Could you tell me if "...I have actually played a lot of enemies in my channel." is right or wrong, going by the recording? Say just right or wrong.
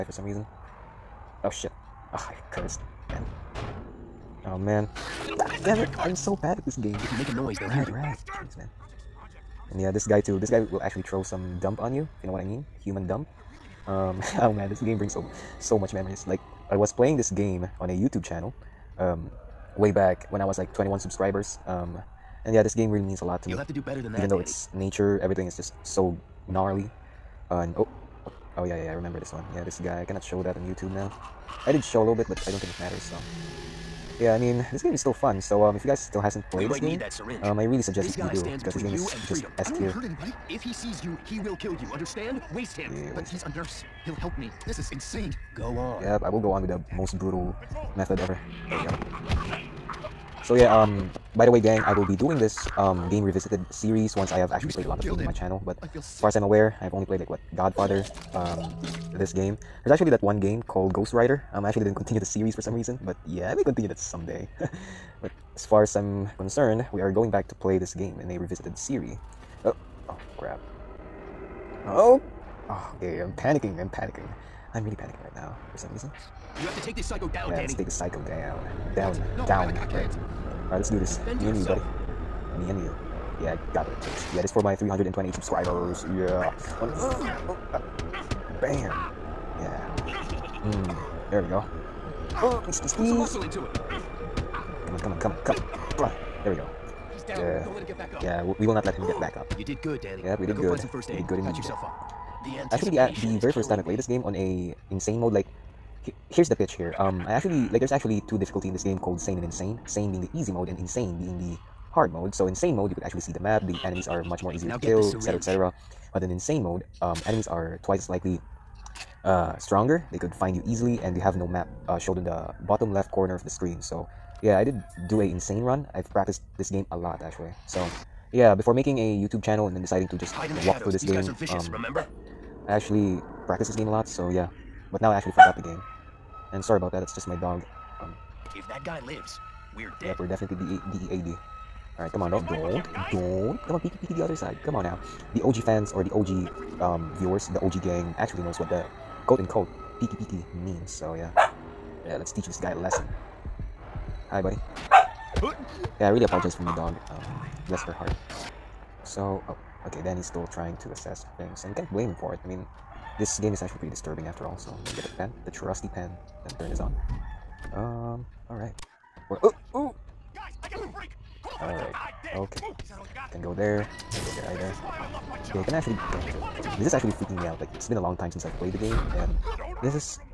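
wrong.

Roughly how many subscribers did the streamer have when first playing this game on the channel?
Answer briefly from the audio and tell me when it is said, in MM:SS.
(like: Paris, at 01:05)
21, at 00:20.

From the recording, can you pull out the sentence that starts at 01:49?
Sane being the easy mode and insane being the hard mode.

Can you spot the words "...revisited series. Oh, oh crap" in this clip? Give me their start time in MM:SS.
01:08.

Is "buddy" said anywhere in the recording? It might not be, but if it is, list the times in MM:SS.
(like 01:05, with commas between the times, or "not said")
01:21, 02:34.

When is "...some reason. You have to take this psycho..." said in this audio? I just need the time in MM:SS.
01:15.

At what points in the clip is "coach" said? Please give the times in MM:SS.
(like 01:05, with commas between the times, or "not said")
not said.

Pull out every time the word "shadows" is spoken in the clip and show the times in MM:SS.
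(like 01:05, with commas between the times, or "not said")
02:10.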